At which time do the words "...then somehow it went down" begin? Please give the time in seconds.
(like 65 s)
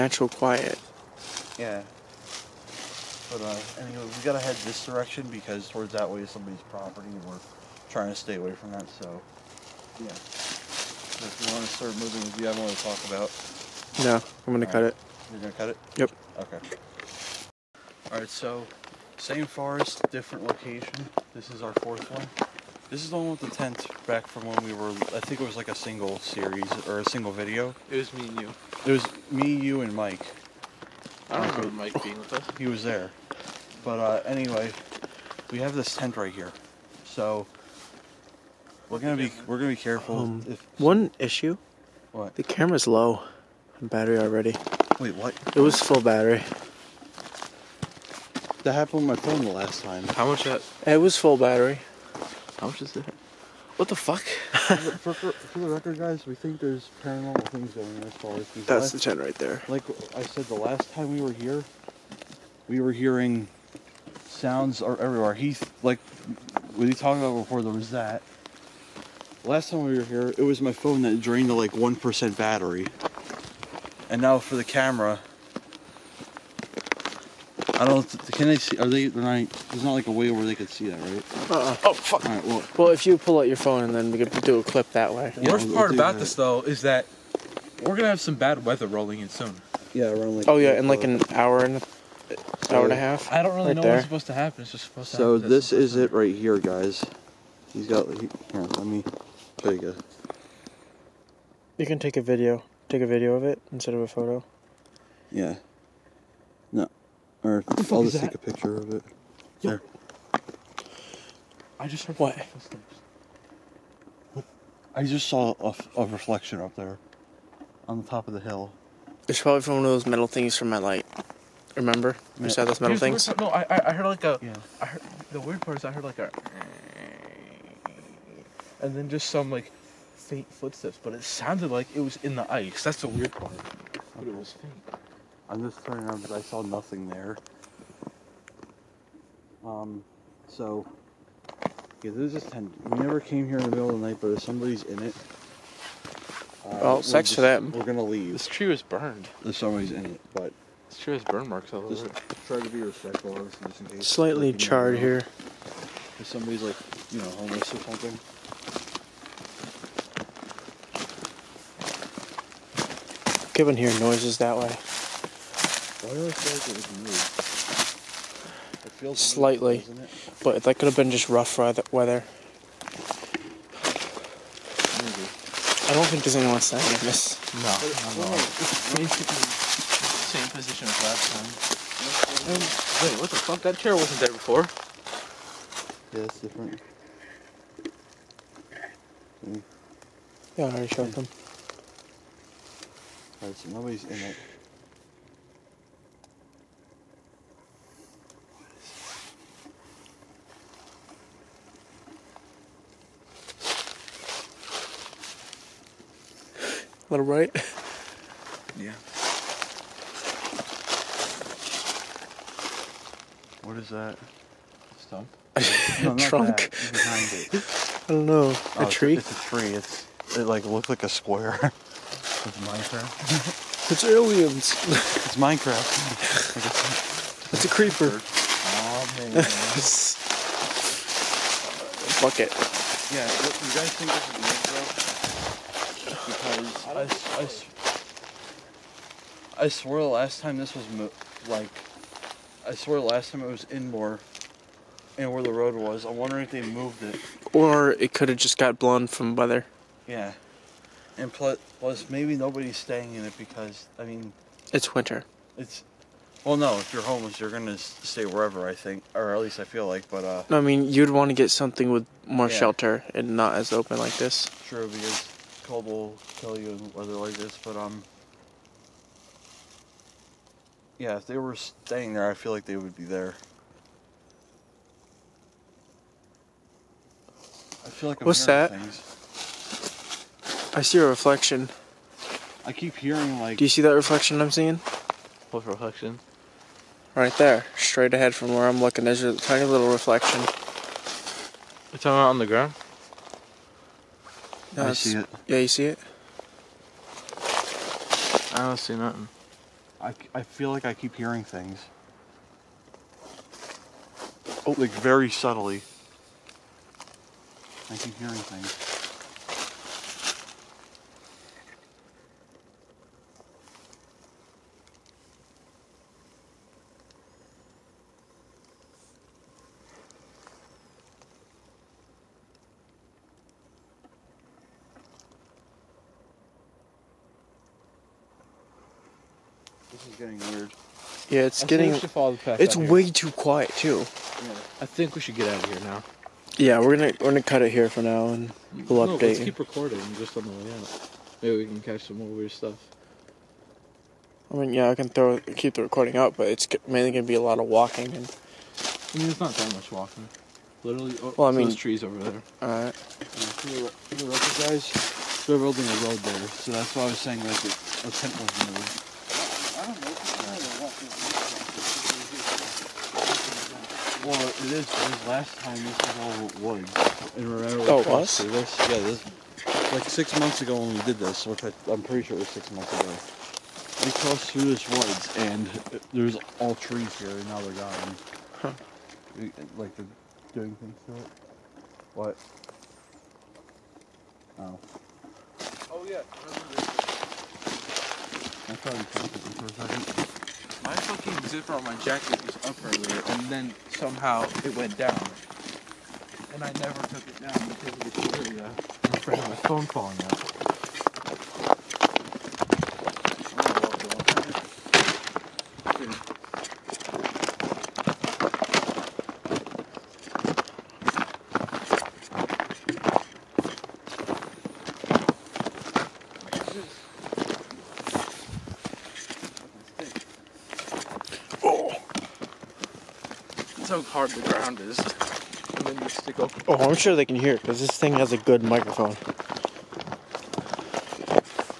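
393 s.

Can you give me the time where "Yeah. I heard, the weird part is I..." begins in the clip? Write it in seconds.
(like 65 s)
124 s.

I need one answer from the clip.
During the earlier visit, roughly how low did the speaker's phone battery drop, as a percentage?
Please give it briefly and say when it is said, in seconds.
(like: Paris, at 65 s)
1 percent, at 71 s.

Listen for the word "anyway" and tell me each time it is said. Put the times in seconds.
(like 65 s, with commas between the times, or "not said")
3 s, 34 s.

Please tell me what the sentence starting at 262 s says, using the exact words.
shelter and not as open like this.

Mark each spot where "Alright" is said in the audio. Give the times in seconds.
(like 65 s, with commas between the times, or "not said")
18 s, 193 s.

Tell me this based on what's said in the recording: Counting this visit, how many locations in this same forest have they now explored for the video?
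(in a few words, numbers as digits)
fourth.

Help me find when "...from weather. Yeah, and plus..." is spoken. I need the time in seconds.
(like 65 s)
249 s.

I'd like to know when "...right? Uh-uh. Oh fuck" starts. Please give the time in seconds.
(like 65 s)
80 s.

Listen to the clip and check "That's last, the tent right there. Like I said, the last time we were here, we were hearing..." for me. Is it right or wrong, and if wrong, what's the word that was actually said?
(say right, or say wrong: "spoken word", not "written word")
right.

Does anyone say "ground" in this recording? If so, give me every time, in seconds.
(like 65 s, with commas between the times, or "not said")
292 s, 424 s.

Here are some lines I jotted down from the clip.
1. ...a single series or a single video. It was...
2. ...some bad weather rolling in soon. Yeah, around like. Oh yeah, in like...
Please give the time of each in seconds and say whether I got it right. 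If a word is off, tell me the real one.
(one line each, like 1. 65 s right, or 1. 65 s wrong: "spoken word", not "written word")
1. 25 s right
2. 88 s right.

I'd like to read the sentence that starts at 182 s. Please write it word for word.
And, um, wait, what the fuck?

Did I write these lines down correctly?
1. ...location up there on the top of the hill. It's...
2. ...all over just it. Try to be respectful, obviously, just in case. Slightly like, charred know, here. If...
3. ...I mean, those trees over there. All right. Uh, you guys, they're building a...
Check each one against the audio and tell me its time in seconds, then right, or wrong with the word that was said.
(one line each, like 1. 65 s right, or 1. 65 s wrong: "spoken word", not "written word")
1. 116 s wrong: "reflection", not "location"
2. 151 s right
3. 351 s right.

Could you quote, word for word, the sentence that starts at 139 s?
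Um, so, yeah, there's this tent.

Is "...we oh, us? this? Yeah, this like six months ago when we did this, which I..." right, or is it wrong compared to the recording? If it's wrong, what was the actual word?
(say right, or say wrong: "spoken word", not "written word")
right.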